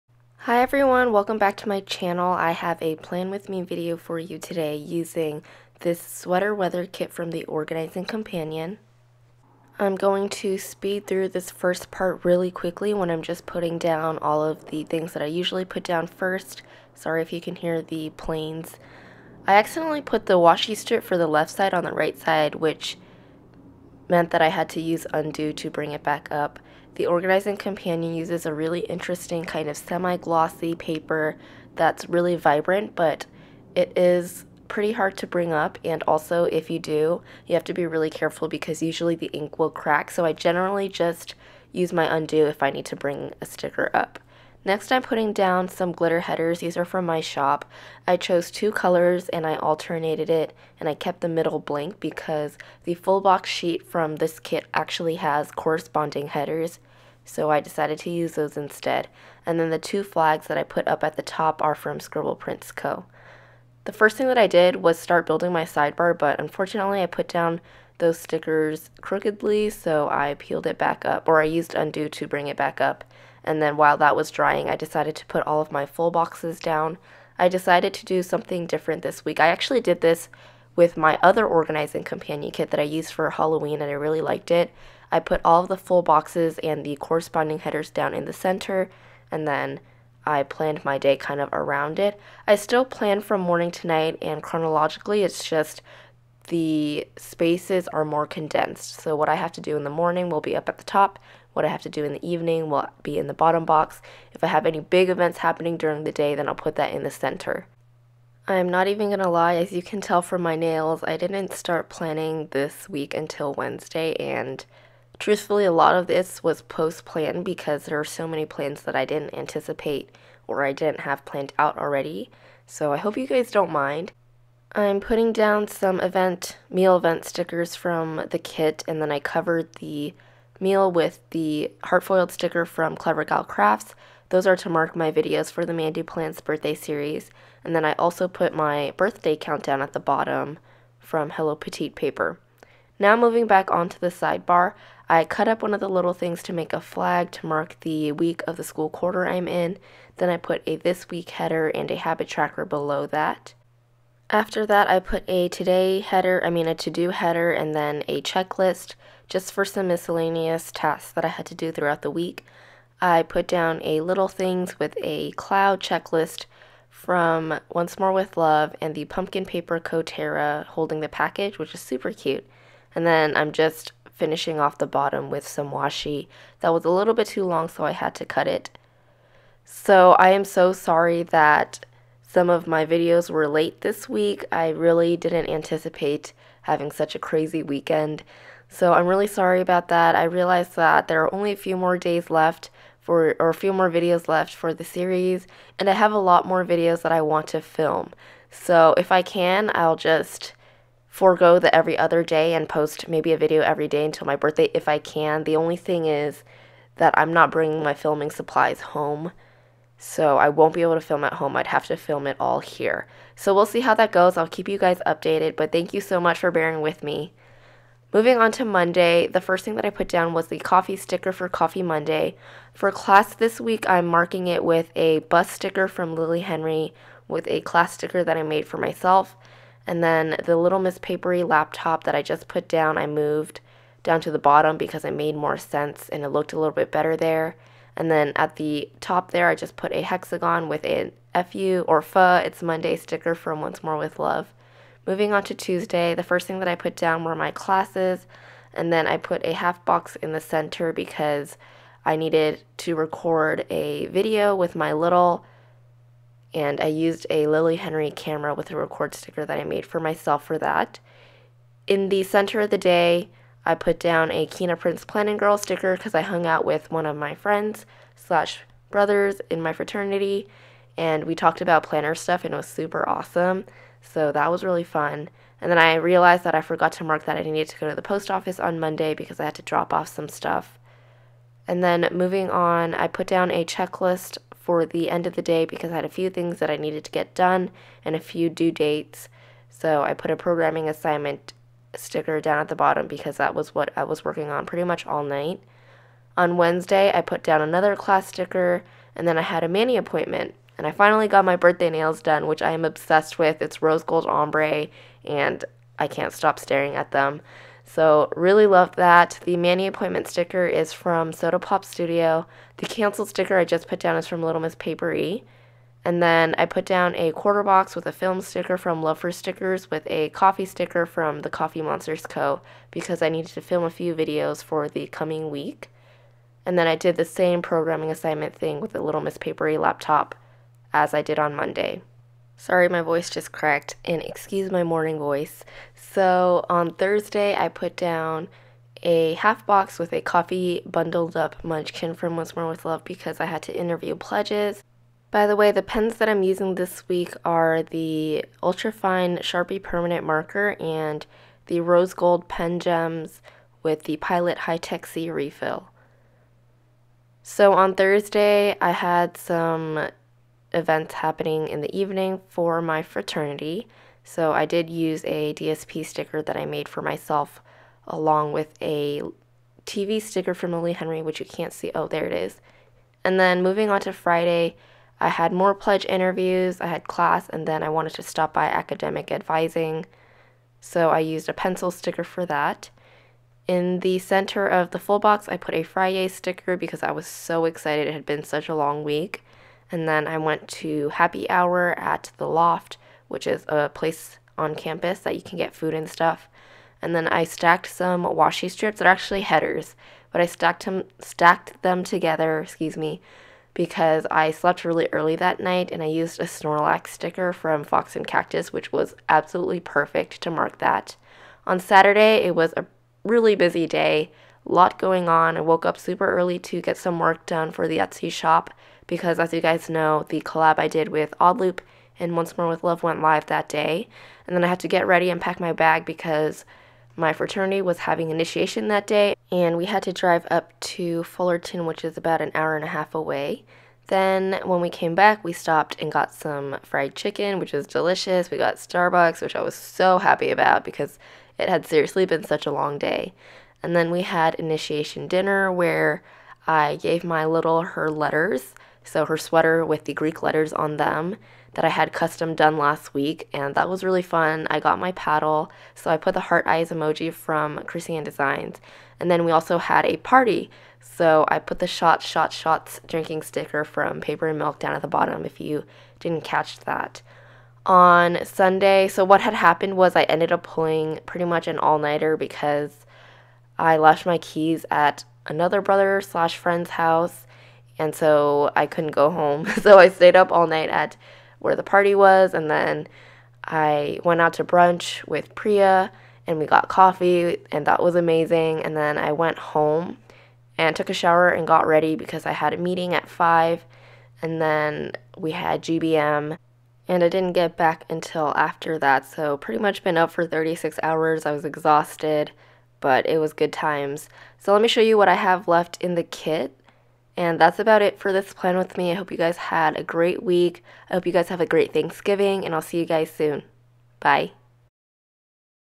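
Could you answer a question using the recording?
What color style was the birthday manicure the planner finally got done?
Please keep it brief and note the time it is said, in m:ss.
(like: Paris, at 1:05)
Rose gold ombre, at 5:03.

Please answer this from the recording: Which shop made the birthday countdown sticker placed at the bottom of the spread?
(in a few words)
Hello Petite paper.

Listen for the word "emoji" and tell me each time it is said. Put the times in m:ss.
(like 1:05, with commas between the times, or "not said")
7:36.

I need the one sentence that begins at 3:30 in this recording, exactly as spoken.
So I won't be able to film at home.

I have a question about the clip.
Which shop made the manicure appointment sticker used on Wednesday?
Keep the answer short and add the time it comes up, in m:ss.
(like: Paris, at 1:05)
Soda Pop Studio, at 5:11.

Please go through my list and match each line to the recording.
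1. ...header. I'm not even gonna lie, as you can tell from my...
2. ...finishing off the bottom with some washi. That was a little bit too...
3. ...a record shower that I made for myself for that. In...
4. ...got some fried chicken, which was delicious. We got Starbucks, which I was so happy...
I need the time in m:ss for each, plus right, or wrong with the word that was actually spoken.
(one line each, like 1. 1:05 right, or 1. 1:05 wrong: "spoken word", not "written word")
1. 1:47 wrong: "center", not "header"
2. 2:54 right
3. 4:18 wrong: "sticker", not "shower"
4. 7:16 right.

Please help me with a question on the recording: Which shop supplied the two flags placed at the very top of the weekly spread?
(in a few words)
Scribble Prints Co.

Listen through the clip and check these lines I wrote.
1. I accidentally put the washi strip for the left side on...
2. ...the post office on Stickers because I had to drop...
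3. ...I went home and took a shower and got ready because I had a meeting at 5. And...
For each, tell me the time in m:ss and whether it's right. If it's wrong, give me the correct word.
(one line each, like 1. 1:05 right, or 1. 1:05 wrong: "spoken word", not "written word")
1. 0:19 right
2. 4:37 wrong: "Monday", not "Stickers"
3. 8:09 right.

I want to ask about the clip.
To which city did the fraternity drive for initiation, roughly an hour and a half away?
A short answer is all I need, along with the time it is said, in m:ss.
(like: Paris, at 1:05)
Fullerton, at 7:11.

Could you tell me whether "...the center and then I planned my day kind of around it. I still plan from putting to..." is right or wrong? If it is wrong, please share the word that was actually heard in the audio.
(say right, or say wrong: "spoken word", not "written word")
wrong: "morning", not "putting".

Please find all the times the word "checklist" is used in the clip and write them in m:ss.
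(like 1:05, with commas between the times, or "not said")
2:38, 2:45, 4:43.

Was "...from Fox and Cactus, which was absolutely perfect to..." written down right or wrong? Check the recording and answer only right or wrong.
right.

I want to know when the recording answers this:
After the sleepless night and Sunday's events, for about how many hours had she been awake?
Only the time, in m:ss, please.
8:20.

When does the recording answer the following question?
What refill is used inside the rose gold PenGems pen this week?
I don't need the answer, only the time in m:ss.
5:54.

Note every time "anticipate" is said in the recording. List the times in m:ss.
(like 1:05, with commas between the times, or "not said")
1:59, 3:05.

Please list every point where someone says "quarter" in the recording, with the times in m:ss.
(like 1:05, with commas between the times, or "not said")
2:28, 5:17.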